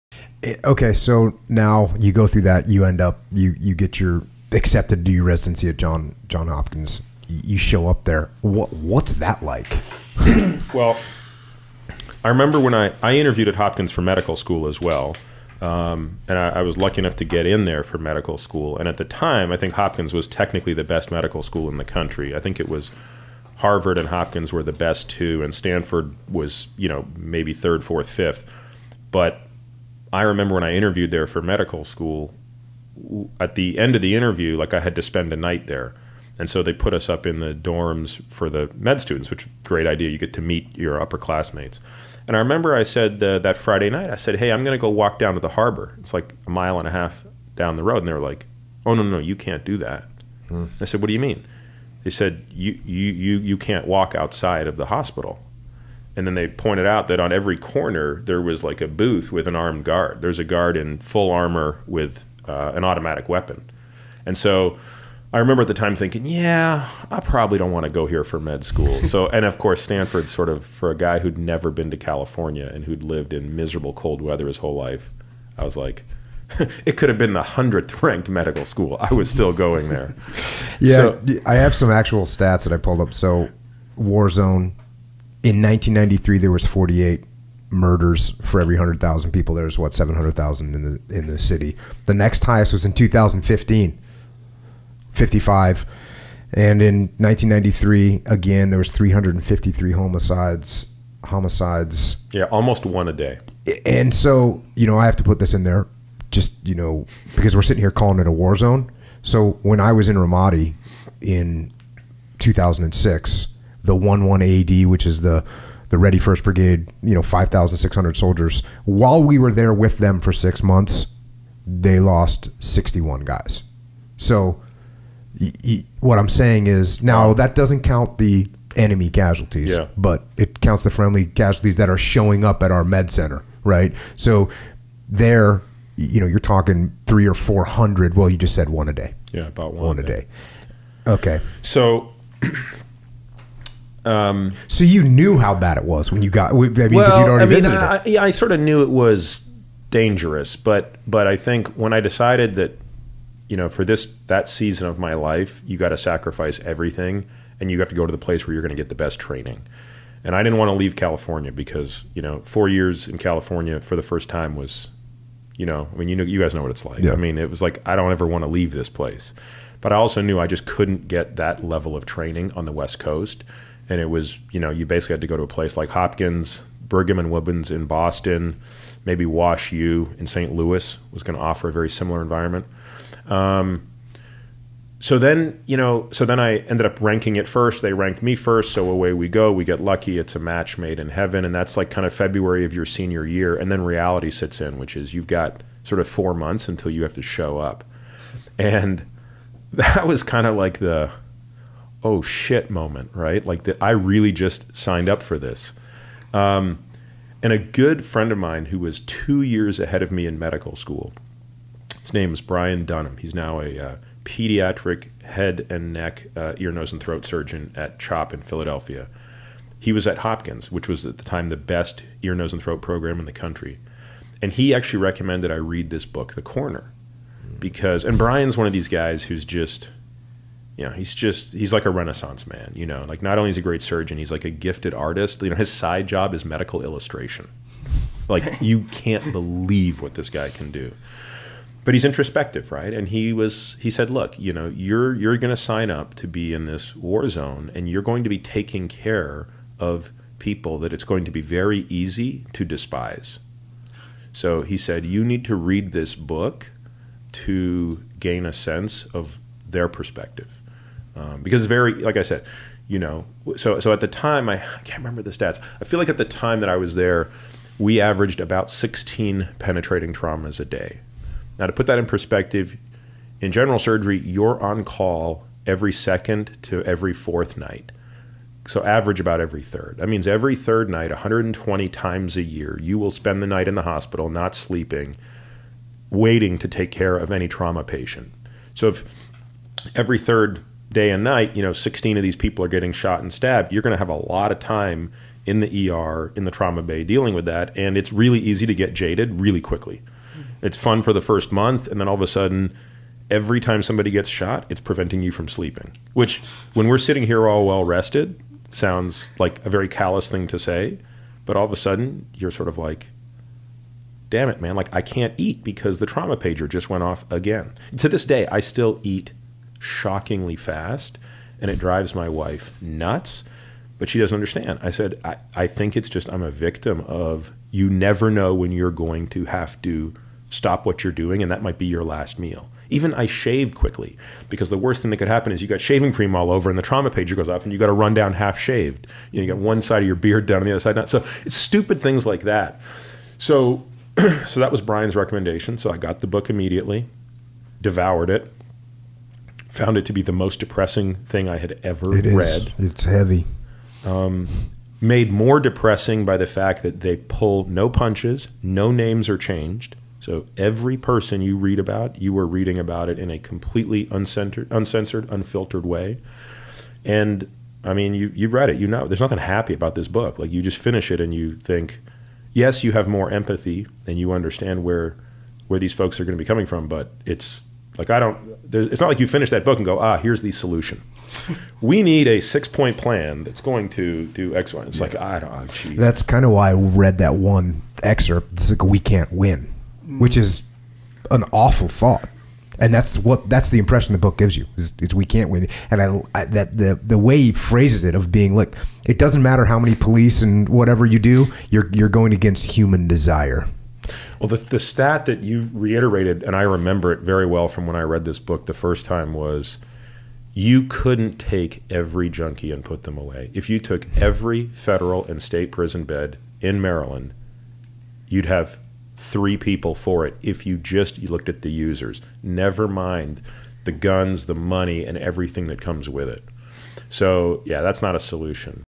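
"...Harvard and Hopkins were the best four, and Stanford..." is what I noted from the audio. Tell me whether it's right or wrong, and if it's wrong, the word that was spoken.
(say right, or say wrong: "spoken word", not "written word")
wrong: "two", not "four".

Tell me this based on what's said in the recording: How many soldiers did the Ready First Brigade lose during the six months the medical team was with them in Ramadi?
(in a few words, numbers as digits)
61.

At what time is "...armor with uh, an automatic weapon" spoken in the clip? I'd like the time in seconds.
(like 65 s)
61 s.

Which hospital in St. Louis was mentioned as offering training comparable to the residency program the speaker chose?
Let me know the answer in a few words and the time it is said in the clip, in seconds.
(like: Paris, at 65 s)
Wash U, at 179 s.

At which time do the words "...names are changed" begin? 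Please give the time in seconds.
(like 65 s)
358 s.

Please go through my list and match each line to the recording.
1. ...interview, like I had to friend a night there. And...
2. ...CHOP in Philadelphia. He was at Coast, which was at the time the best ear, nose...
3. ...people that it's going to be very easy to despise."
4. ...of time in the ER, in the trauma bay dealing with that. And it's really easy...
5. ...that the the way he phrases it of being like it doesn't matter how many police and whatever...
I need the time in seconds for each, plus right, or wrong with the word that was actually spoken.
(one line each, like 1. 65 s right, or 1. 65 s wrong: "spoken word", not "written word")
1. 34 s wrong: "spend", not "friend"
2. 217 s wrong: "Hopkins", not "Coast"
3. 250 s right
4. 294 s right
5. 396 s right.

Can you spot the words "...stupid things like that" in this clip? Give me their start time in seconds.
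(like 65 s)
341 s.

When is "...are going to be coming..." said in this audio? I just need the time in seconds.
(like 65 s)
376 s.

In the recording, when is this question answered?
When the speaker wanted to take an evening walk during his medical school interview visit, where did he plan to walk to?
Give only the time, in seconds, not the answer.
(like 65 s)
45 s.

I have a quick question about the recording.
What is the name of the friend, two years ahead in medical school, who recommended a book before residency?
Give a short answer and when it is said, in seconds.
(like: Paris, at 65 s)
Brian Dunham, at 212 s.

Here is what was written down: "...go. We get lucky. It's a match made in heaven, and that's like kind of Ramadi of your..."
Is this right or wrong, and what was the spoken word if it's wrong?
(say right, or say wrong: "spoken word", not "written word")
wrong: "February", not "Ramadi".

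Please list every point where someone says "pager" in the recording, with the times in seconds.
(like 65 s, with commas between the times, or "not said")
316 s, 337 s.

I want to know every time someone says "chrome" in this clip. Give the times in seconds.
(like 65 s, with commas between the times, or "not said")
not said.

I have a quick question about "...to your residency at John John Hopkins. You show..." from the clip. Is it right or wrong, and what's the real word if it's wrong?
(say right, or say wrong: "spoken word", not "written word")
right.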